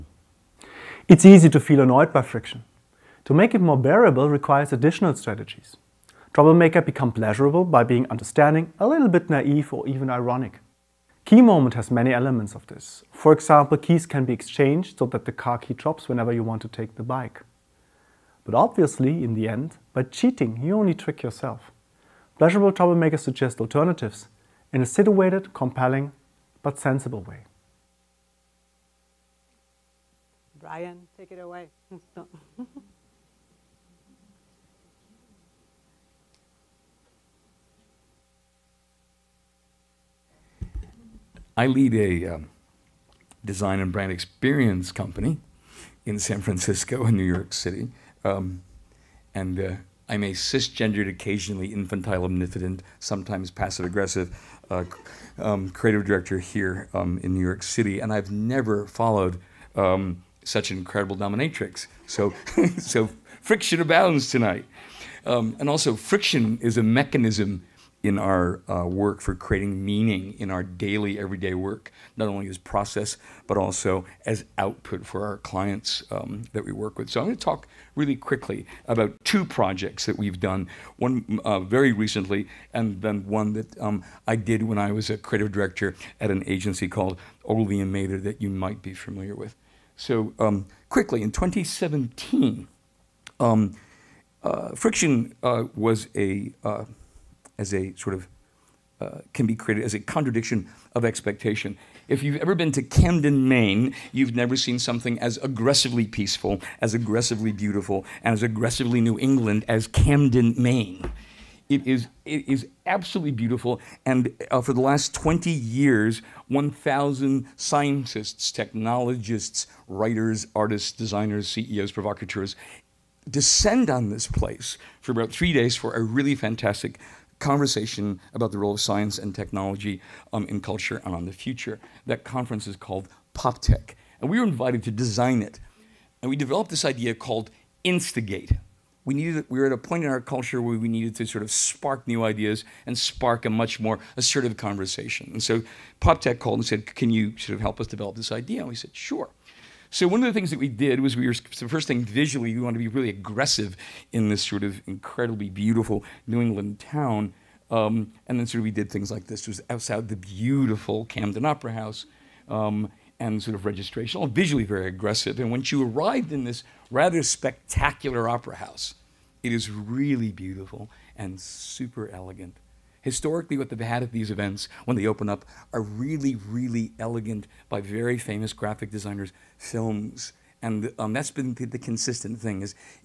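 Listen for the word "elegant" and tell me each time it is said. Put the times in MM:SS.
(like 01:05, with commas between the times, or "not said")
02:52, 02:56.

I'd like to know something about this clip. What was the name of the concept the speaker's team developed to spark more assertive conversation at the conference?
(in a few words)
Instigate.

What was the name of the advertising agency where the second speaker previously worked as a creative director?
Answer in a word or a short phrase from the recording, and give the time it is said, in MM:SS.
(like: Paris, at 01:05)
Ogilvy and Mather, at 01:27.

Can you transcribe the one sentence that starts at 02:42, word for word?
Um, and sort of registration all visually very aggressive.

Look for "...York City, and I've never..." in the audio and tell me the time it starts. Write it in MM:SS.
00:57.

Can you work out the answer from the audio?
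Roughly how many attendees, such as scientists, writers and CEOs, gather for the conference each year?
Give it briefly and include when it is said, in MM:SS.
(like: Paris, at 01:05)
1,000, at 01:56.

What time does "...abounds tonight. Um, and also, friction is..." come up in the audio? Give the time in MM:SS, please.
01:03.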